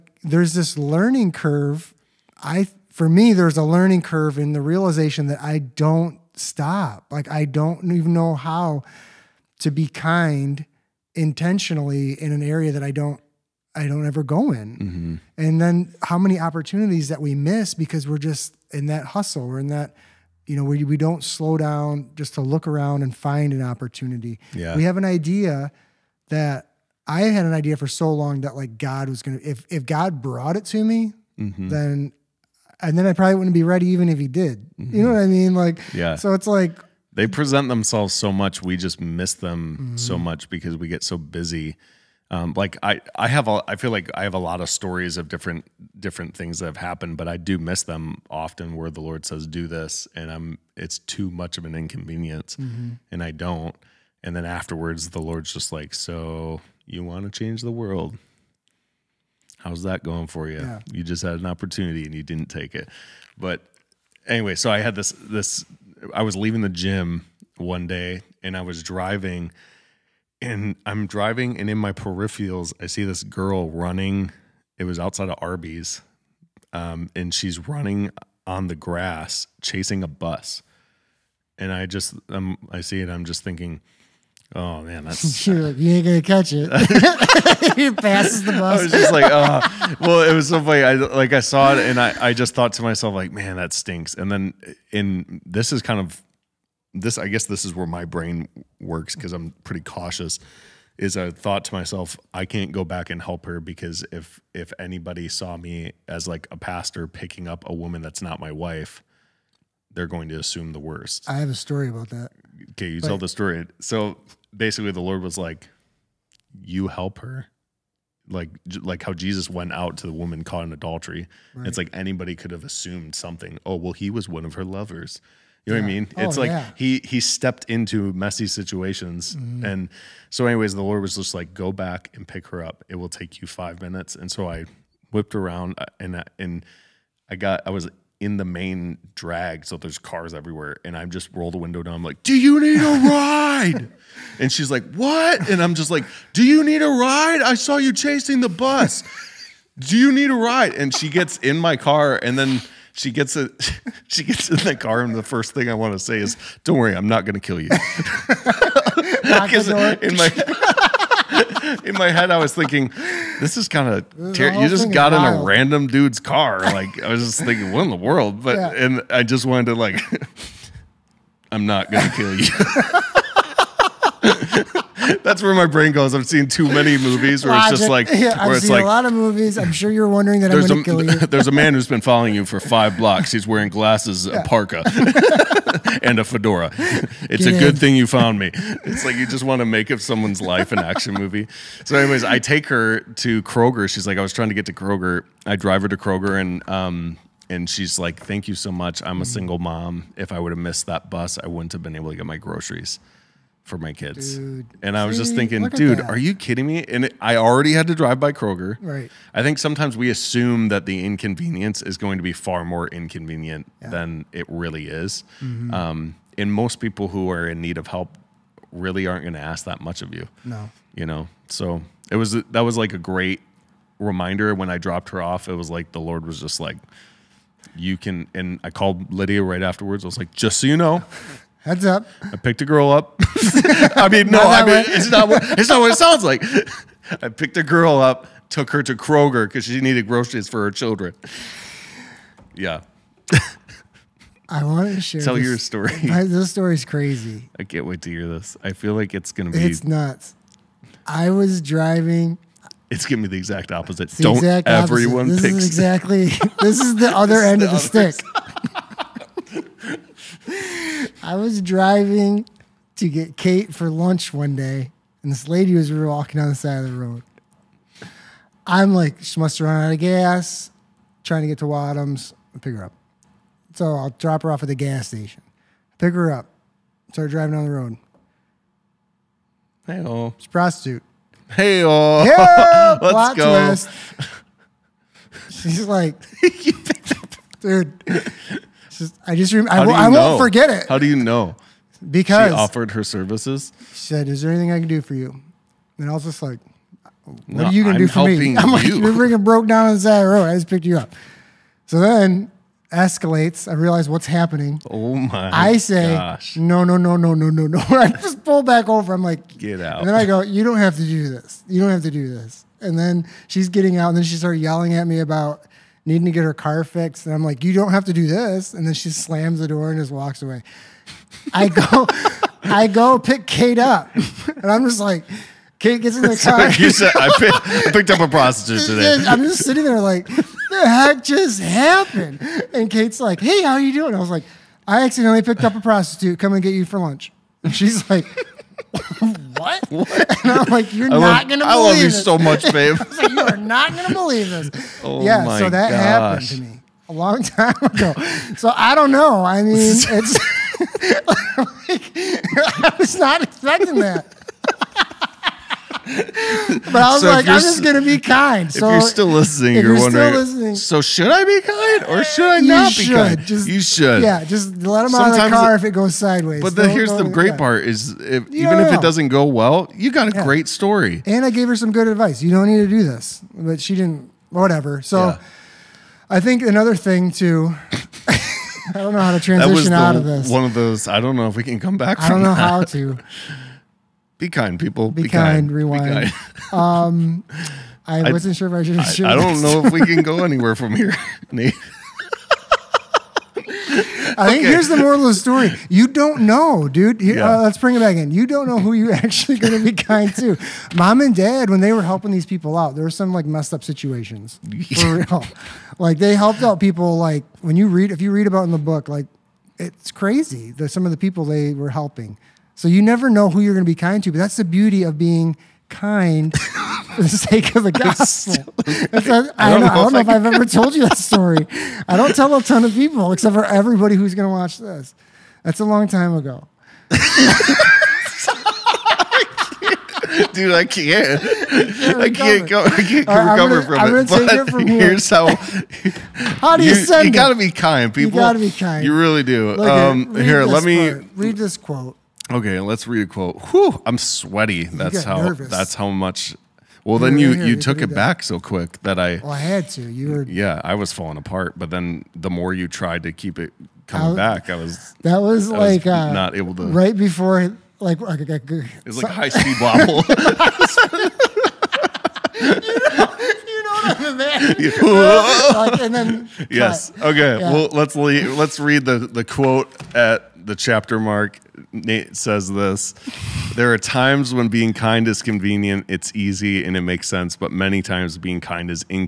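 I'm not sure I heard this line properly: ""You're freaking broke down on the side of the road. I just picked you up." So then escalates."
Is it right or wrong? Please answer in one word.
right.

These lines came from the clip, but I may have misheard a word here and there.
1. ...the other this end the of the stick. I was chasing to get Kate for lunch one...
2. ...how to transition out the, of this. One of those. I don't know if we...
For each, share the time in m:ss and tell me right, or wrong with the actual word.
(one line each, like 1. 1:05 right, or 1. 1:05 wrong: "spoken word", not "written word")
1. 4:16 wrong: "driving", not "chasing"
2. 6:19 right.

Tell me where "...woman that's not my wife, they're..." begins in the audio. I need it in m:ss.
1:47.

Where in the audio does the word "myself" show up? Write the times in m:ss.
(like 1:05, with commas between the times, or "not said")
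1:32, 1:41.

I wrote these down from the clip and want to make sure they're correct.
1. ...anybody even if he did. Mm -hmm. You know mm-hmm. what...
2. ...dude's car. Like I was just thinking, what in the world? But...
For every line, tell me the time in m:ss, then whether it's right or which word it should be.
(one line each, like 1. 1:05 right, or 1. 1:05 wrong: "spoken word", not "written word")
1. 0:33 wrong: "ready", not "anybody"
2. 2:45 right.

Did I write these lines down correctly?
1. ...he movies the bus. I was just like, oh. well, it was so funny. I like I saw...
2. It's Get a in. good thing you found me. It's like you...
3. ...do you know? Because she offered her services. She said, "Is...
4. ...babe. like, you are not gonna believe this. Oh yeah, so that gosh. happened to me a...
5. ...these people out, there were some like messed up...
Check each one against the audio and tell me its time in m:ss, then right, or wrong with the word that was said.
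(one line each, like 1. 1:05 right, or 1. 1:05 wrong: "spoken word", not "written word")
1. 1:27 wrong: "passes", not "movies"
2. 3:06 right
3. 4:50 right
4. 5:42 right
5. 6:42 right.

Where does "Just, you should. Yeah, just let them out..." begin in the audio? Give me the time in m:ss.
6:03.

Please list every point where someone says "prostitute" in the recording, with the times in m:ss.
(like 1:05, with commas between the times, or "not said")
4:40, 5:28, 5:35.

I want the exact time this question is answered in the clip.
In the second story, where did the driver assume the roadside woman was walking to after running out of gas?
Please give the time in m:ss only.
4:31.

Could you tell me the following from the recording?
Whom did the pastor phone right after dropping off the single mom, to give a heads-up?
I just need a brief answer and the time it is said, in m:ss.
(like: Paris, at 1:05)
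Lydia, at 3:49.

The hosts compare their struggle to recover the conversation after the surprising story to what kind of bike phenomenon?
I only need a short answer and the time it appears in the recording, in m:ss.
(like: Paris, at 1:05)
High speed wobble, at 7:39.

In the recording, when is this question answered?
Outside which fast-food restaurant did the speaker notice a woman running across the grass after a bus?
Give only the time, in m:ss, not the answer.
1:15.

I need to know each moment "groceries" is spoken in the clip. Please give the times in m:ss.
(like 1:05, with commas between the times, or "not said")
3:22, 4:00.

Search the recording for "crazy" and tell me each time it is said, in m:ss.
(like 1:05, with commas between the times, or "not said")
4:06, 6:50.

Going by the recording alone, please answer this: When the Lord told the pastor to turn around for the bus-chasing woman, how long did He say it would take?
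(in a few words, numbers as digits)
5 minutes.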